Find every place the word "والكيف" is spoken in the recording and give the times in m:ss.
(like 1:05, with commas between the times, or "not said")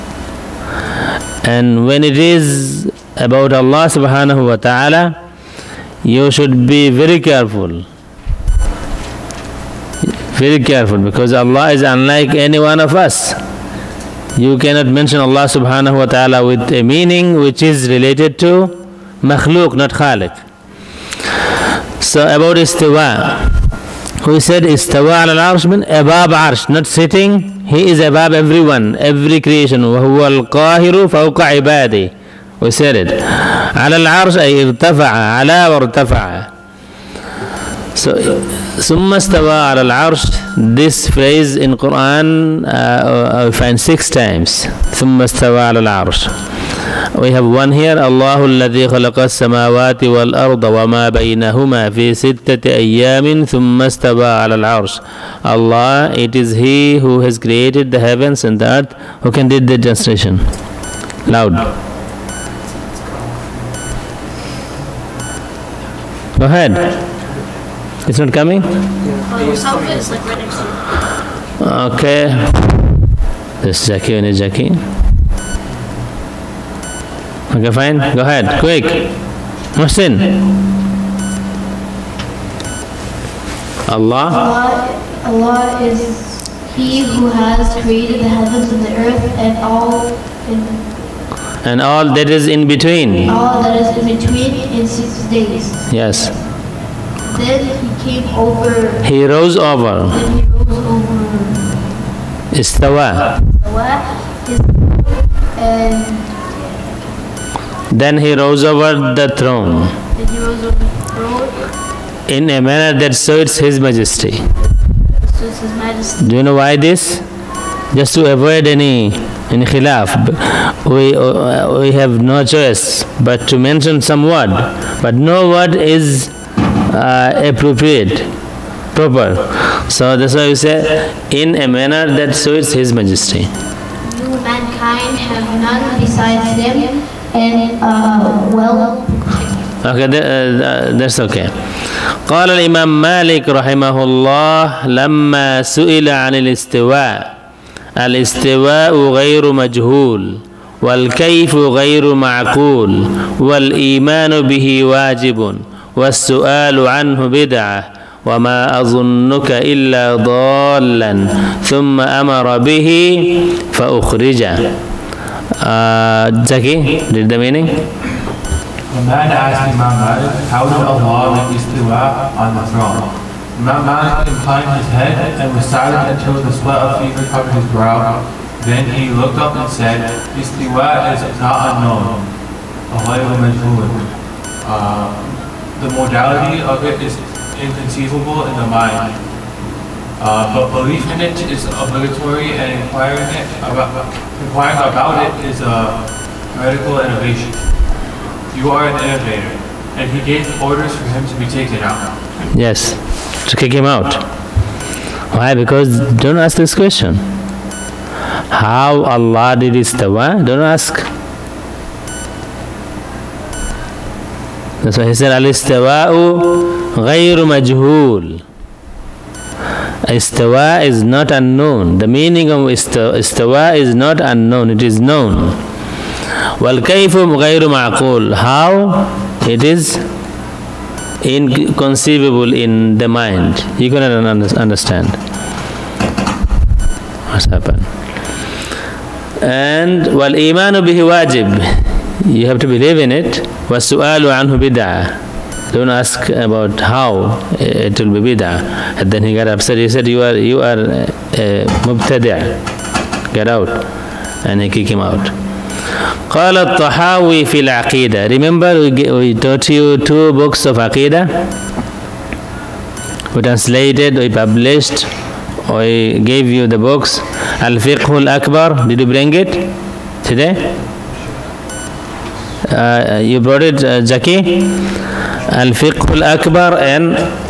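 2:30, 3:46.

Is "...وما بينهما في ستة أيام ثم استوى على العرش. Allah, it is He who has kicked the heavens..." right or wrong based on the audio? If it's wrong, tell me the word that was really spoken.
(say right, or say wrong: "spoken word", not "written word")
wrong: "created", not "kicked".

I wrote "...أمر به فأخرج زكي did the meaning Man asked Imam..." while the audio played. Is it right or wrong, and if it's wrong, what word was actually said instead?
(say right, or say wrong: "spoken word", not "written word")
right.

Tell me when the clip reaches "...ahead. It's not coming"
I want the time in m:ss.
1:06.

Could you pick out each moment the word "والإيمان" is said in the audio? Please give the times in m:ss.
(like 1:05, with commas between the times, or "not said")
2:33, 4:00.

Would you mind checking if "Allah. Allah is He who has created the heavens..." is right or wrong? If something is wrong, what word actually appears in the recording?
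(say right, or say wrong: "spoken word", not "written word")
right.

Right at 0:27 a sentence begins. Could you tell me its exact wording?
He is above everyone, every creation.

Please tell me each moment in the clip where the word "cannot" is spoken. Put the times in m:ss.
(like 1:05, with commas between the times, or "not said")
0:14, 3:53.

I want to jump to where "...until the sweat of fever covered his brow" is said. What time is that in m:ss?
2:56.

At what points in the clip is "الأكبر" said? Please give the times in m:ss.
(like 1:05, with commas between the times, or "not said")
4:28, 4:36.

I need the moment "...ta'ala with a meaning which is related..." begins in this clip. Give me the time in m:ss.
0:16.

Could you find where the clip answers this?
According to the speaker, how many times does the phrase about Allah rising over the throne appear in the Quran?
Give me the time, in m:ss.
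0:43.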